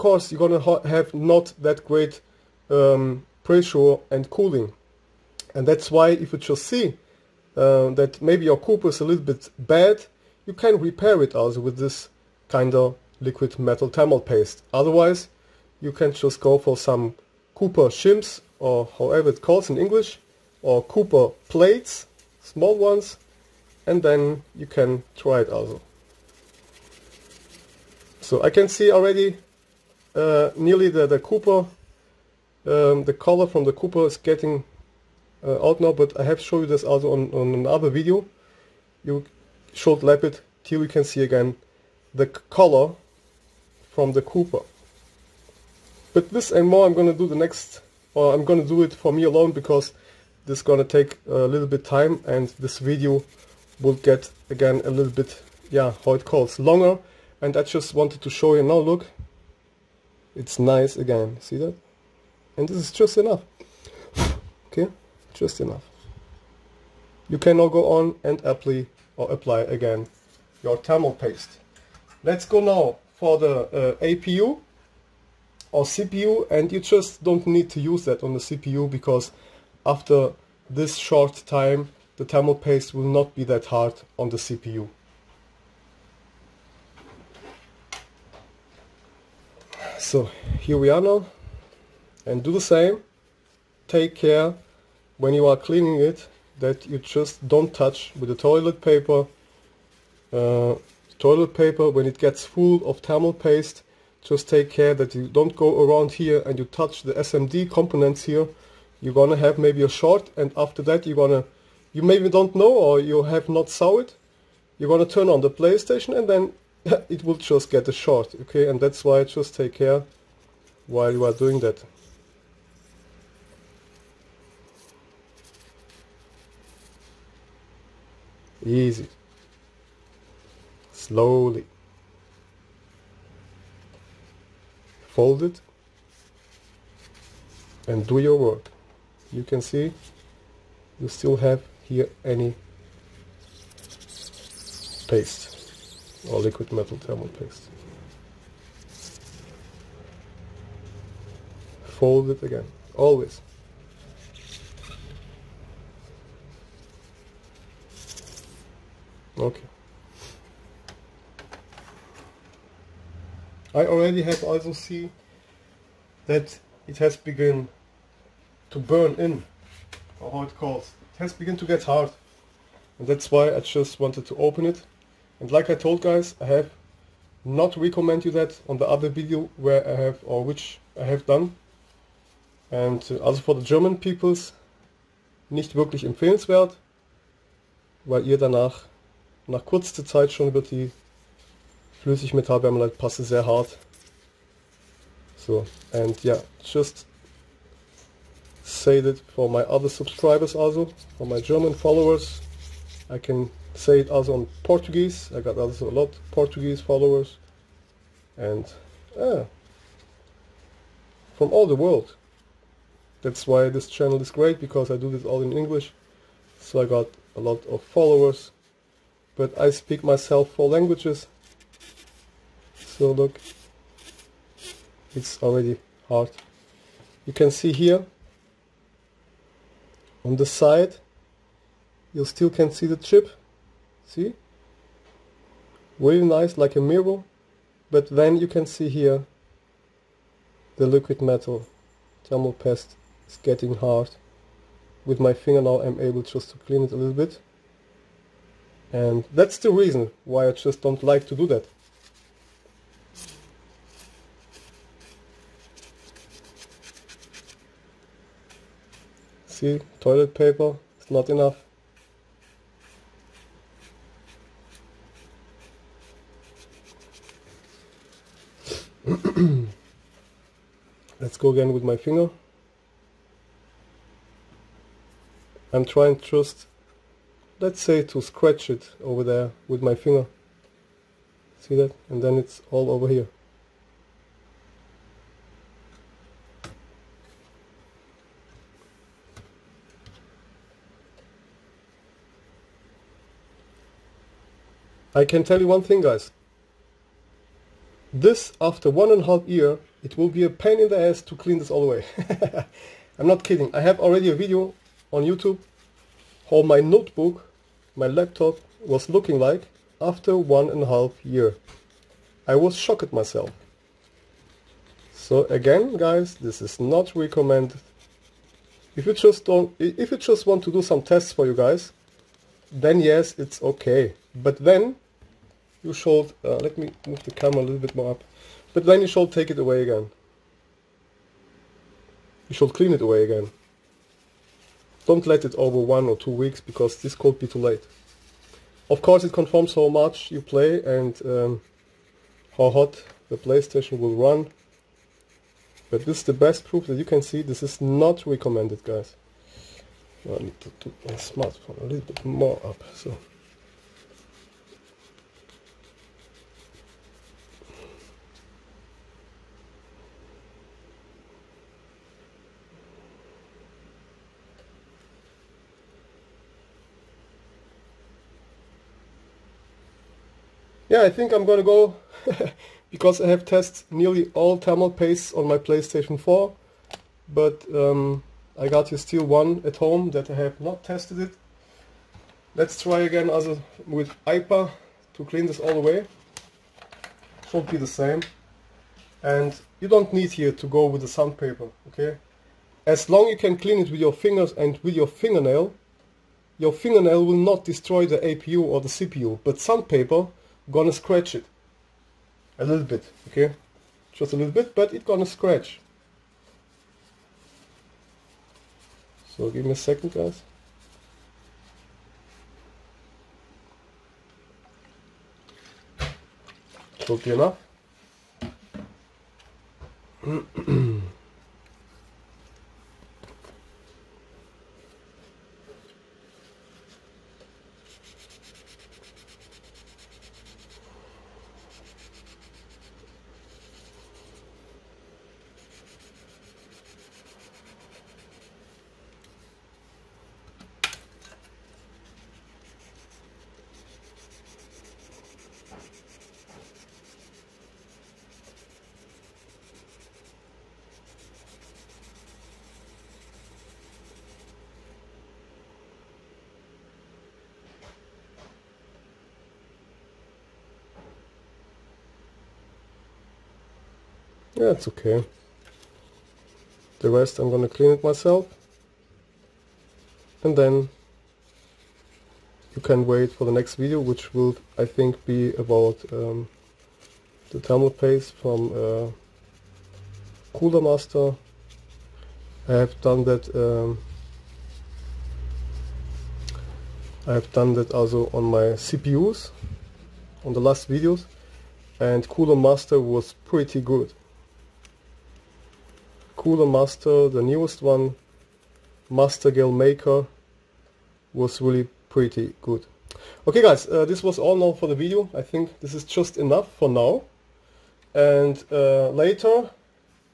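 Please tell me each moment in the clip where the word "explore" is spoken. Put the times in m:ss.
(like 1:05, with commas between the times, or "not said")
not said.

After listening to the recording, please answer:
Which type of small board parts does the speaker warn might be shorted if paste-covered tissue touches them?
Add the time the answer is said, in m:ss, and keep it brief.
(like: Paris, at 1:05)
SMD components, at 1:47.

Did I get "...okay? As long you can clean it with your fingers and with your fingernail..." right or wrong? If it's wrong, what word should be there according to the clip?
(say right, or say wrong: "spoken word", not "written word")
right.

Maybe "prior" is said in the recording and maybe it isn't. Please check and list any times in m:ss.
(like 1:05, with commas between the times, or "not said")
not said.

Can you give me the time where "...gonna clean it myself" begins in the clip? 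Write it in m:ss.
7:47.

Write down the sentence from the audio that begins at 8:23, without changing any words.
Okay guys, uh, this was all now for the video.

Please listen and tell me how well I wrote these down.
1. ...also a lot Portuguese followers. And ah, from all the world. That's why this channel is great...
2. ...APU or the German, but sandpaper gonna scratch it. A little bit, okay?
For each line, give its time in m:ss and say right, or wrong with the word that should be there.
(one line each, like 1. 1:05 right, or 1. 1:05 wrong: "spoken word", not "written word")
1. 3:25 right
2. 6:38 wrong: "CPU", not "German".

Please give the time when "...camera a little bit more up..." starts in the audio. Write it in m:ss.
5:27.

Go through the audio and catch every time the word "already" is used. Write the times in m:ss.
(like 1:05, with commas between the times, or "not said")
0:28, 2:43, 3:45, 5:03.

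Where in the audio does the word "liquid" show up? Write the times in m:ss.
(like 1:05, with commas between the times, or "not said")
0:13, 2:26, 4:00.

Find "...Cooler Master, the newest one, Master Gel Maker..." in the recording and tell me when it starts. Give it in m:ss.
8:16.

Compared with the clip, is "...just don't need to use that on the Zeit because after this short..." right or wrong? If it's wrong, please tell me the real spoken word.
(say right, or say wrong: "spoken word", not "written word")
wrong: "CPU", not "Zeit".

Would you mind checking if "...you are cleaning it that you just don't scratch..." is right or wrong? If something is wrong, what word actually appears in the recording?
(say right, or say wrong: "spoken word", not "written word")
wrong: "touch", not "scratch".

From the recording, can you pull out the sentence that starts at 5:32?
You should clean it away again.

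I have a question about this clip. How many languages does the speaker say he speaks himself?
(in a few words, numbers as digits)
4.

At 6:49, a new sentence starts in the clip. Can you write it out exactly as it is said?
So, give me a second, guys.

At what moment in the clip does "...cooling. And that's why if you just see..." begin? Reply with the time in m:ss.
0:04.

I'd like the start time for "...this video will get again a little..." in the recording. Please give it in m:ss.
0:52.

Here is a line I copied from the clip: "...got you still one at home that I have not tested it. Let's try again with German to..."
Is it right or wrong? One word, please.
wrong.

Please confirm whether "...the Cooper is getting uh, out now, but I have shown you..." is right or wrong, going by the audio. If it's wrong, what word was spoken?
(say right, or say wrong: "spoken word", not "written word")
right.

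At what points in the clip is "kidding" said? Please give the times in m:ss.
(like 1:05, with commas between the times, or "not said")
5:03.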